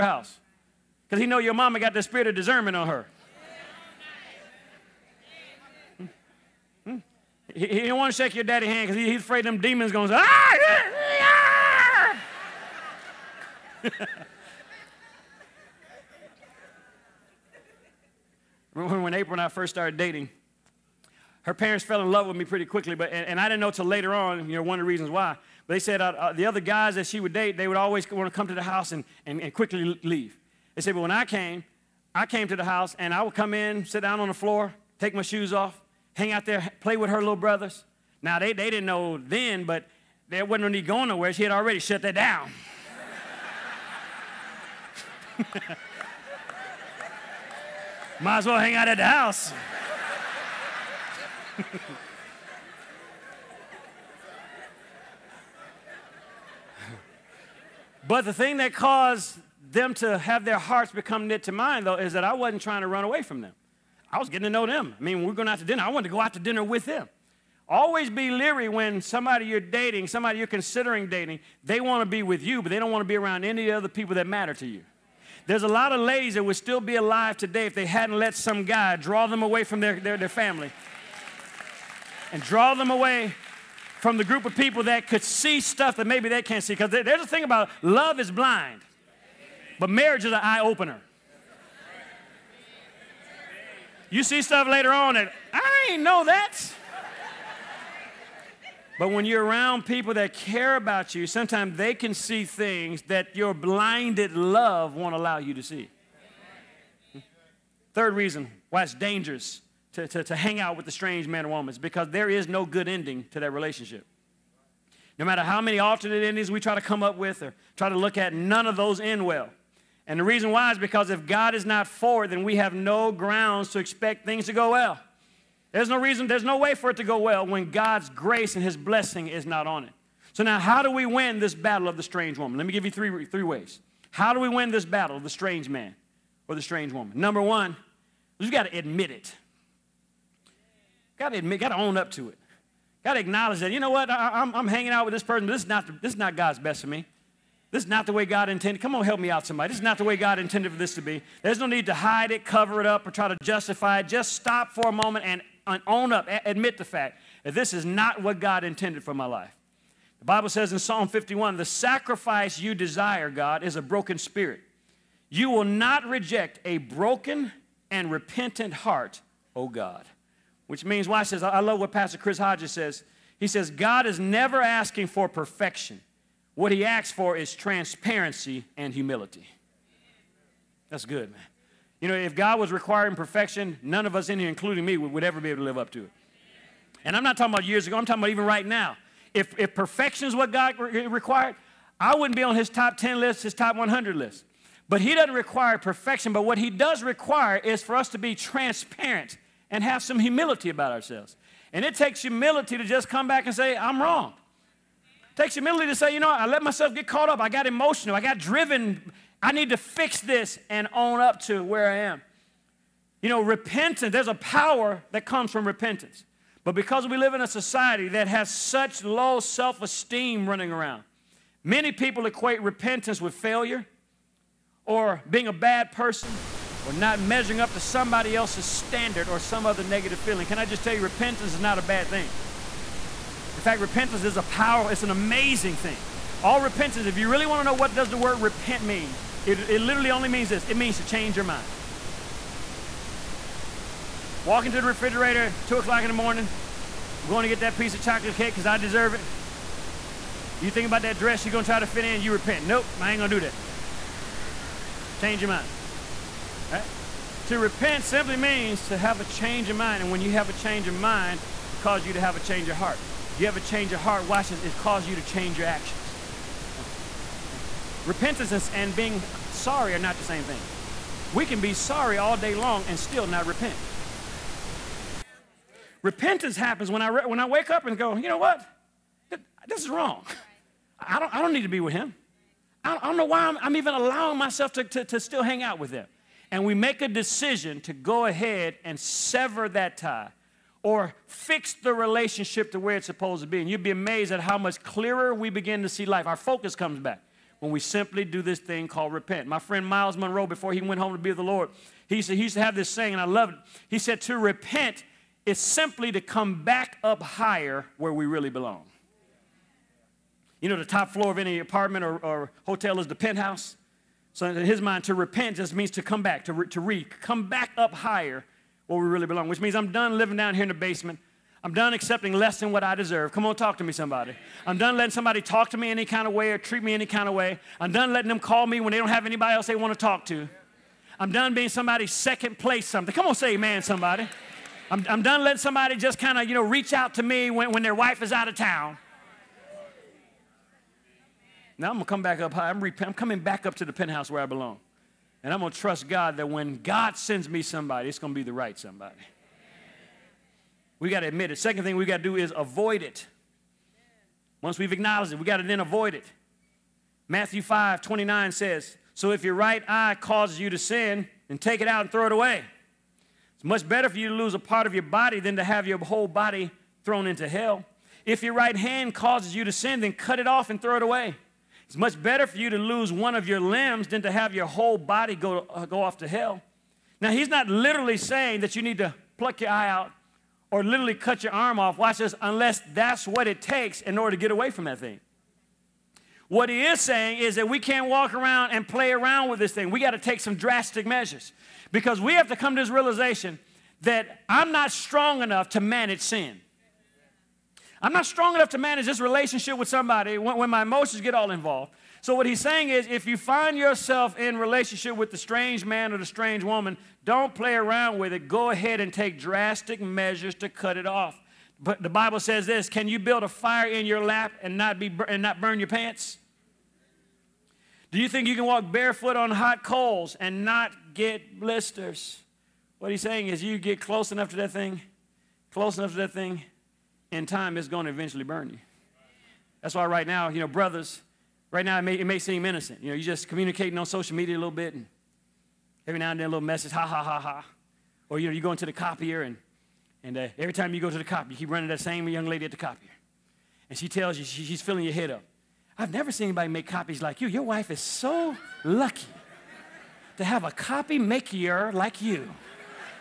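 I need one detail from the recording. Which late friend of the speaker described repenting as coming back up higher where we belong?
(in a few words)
Myles Munroe.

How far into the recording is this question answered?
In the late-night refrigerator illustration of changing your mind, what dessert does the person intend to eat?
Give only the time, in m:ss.
4:08.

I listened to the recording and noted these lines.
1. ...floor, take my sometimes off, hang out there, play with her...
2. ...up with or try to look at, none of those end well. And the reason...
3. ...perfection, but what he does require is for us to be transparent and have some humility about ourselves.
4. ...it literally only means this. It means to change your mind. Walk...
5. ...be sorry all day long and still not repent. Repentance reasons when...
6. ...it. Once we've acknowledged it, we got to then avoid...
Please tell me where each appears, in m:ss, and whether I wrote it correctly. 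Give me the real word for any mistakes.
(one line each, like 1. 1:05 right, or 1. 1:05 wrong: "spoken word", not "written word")
1. 0:34 wrong: "shoes", not "sometimes"
2. 1:57 right
3. 3:15 right
4. 3:59 right
5. 4:31 wrong: "happens", not "reasons"
6. 5:53 right.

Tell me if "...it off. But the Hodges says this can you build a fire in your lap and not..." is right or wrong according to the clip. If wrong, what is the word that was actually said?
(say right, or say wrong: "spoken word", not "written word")
wrong: "Bible", not "Hodges".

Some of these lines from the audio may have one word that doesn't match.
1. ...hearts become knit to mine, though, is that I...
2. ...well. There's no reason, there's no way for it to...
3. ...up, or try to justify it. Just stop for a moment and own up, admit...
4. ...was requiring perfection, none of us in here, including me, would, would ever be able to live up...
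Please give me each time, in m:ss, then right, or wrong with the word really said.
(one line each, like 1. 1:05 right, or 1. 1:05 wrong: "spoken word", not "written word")
1. 1:00 right
2. 2:04 right
3. 2:32 right
4. 3:02 right.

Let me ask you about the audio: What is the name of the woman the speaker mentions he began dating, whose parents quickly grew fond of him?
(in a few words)
April.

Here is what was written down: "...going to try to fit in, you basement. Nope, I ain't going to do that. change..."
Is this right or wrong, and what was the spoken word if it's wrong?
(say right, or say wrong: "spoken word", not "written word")
wrong: "repent", not "basement".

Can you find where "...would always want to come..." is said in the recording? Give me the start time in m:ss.
0:27.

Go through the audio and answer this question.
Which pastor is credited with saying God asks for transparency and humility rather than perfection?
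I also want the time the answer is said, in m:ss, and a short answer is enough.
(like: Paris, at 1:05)
Chris Hodges, at 2:52.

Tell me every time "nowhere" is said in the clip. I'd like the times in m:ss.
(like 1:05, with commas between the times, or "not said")
0:41.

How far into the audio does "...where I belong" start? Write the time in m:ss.
5:44.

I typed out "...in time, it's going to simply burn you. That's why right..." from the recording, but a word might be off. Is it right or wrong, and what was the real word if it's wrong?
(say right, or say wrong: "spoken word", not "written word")
wrong: "eventually", not "simply".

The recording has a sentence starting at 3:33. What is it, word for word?
You know, repentance, there's a power that comes from repentance.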